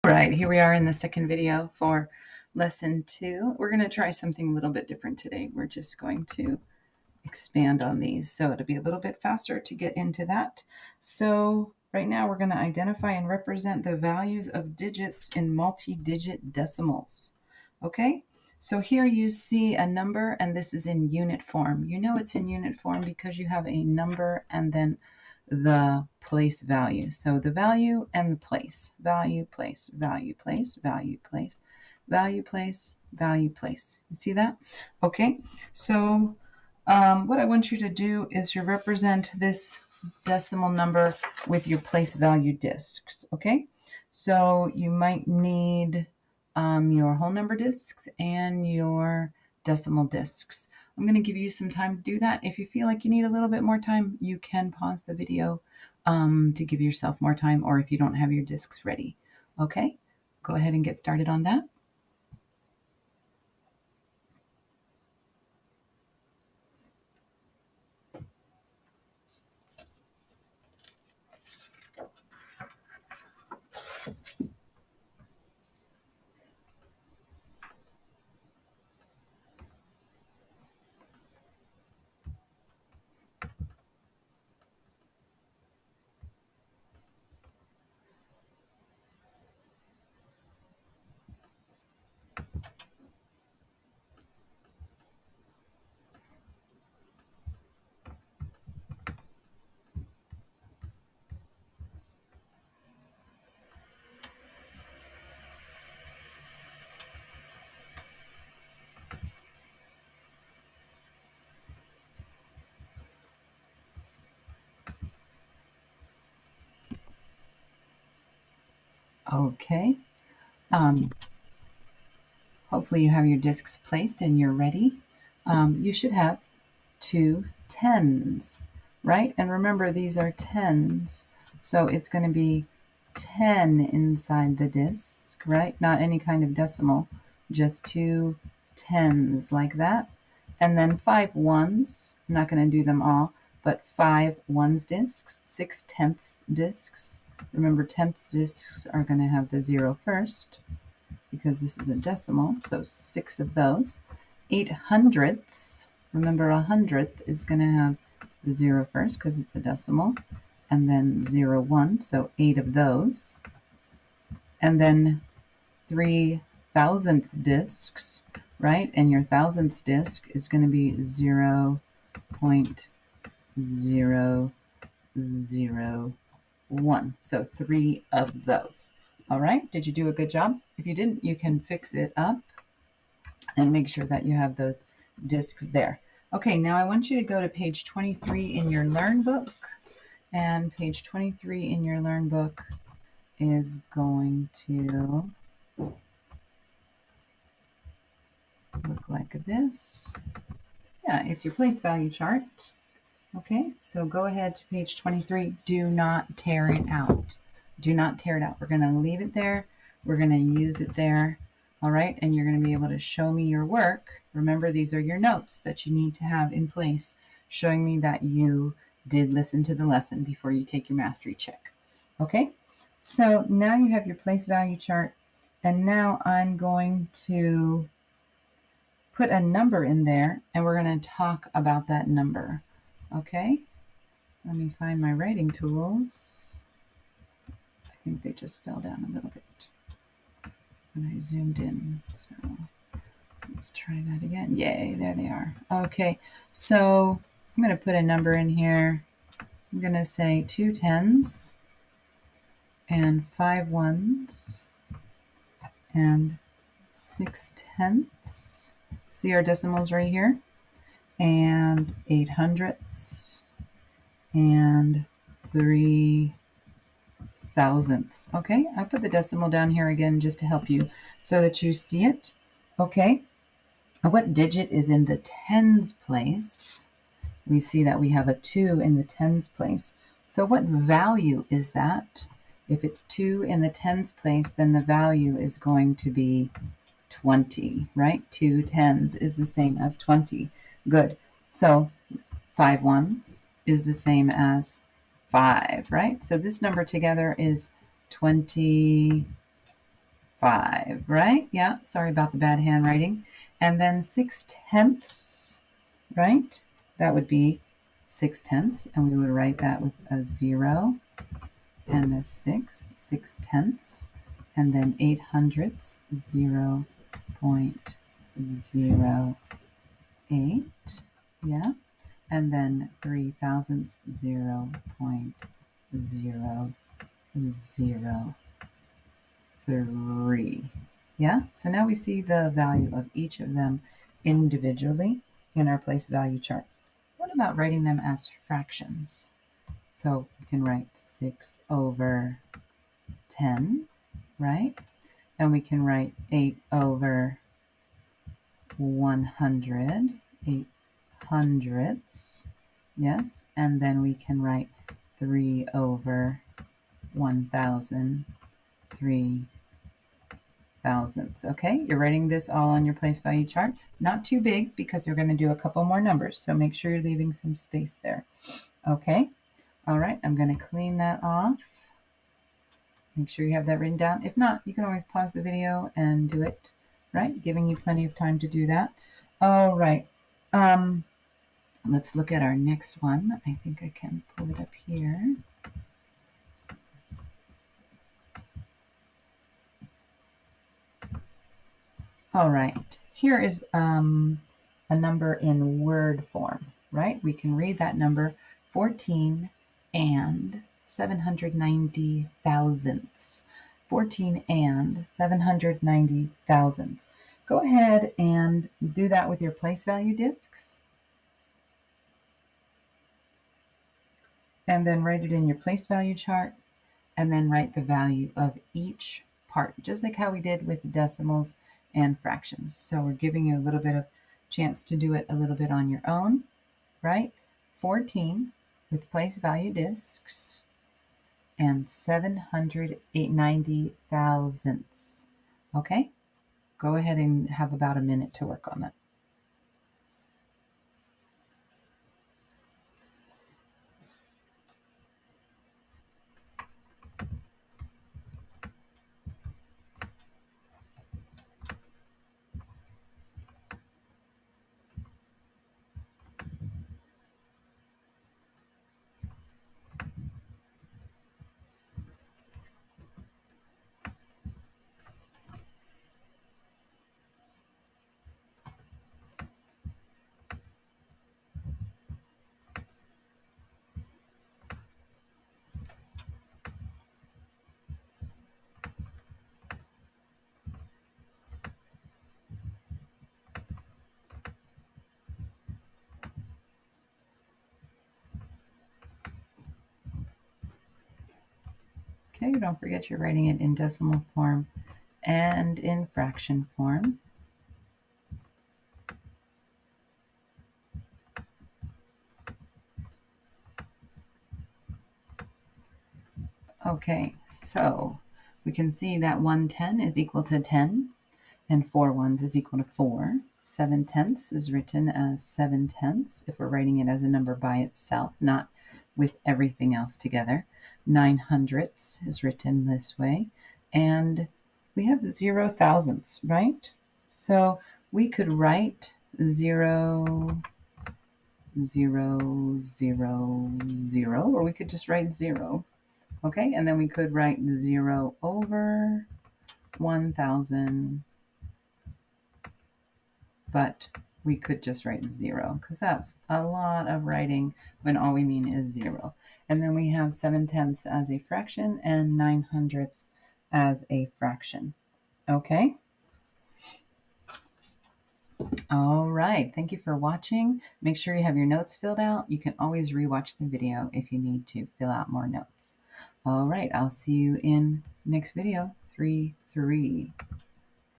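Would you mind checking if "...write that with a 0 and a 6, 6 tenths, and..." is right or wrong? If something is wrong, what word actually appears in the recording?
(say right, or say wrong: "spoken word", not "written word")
right.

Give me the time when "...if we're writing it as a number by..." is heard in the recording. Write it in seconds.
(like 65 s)
516 s.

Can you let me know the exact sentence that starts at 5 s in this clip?
We're just going to expand on these.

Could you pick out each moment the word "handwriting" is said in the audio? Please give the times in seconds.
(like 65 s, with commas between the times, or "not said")
302 s.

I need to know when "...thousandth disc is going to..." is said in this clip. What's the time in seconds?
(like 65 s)
169 s.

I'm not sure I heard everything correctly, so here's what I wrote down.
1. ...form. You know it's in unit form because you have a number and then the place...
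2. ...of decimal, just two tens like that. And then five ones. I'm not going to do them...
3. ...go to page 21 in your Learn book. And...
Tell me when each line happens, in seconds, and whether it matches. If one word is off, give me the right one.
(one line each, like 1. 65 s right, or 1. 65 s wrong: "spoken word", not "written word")
1. 21 s right
2. 136 s right
3. 187 s wrong: "23", not "21".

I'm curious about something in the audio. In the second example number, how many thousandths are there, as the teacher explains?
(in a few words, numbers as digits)
0.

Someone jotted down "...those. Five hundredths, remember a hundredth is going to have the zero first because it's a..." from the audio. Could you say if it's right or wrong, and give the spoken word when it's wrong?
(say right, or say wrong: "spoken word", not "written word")
wrong: "Eight", not "Five".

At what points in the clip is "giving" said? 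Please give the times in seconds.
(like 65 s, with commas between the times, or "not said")
377 s, 423 s.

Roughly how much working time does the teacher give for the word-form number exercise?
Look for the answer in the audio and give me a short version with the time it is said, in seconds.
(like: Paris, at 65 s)
about a minute, at 437 s.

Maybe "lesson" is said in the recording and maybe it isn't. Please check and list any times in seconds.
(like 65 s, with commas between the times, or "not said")
2 s, 219 s.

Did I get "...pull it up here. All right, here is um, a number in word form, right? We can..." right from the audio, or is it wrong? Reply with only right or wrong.
right.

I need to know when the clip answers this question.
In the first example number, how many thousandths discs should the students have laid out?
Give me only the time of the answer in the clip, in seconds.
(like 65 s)
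165 s.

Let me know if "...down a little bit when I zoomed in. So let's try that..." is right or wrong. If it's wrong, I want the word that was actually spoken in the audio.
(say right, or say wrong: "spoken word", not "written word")
right.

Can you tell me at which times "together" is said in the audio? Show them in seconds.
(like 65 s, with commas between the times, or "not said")
296 s, 520 s.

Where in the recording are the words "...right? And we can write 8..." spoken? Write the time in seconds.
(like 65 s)
344 s.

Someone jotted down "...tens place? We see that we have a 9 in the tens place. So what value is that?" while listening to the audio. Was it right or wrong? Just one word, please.
wrong.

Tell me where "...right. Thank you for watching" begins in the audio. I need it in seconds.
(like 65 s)
559 s.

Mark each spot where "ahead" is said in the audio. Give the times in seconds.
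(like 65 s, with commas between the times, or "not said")
60 s, 204 s, 407 s, 436 s.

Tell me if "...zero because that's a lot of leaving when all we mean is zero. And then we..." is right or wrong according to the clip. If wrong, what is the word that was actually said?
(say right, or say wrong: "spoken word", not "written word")
wrong: "writing", not "leaving".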